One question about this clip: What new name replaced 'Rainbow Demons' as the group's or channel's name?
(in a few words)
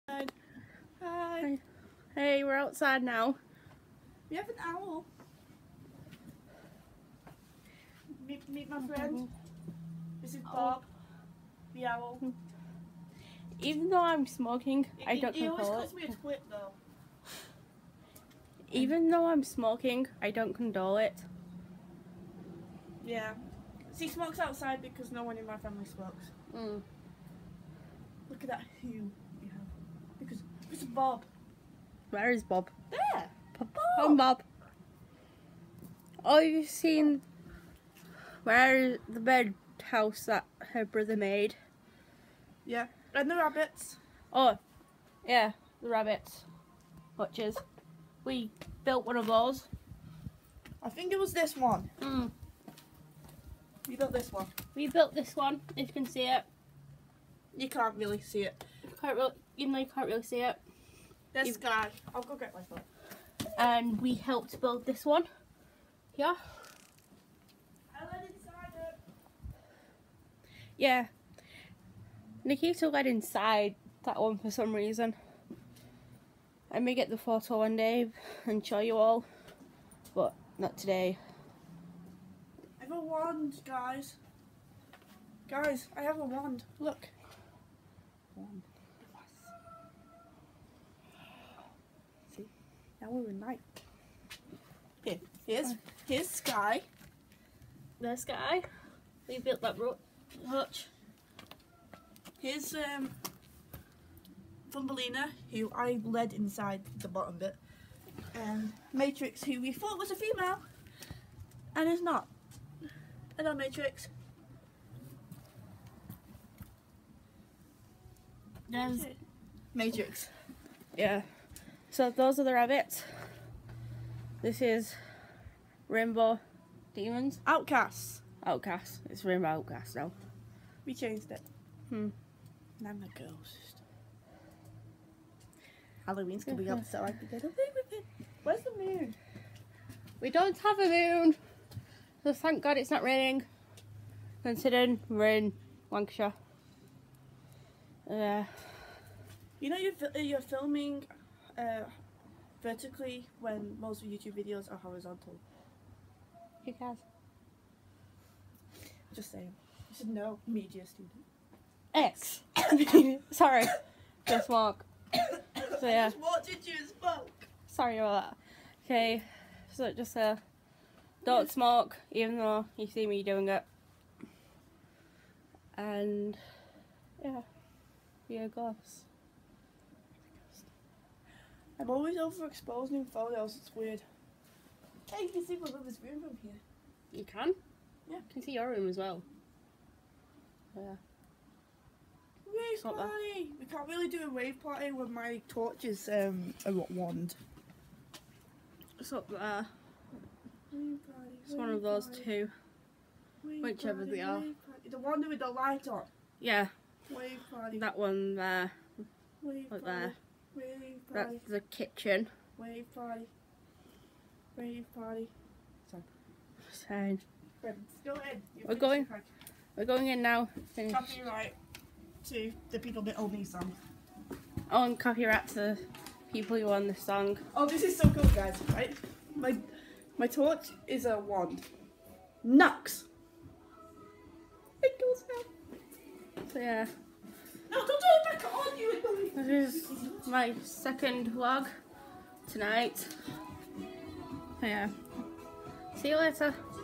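Rainbow Outcasts.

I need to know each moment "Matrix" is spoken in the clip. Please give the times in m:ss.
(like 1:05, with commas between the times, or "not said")
1:48, 1:53, 1:59.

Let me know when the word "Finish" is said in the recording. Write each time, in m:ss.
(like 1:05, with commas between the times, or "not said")
3:40.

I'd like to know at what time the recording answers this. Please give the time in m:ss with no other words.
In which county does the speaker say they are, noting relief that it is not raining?
2:25.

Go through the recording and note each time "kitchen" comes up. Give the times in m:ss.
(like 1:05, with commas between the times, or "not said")
3:31.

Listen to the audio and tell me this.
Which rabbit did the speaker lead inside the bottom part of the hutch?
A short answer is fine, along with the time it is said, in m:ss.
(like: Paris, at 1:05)
Thumbelina, at 1:44.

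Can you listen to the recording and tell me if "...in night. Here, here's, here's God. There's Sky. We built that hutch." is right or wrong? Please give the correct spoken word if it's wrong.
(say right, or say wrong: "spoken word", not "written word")
wrong: "Sky", not "God".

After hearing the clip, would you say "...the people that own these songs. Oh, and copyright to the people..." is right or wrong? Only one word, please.
right.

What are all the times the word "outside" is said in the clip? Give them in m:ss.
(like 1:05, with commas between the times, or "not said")
0:02, 0:24.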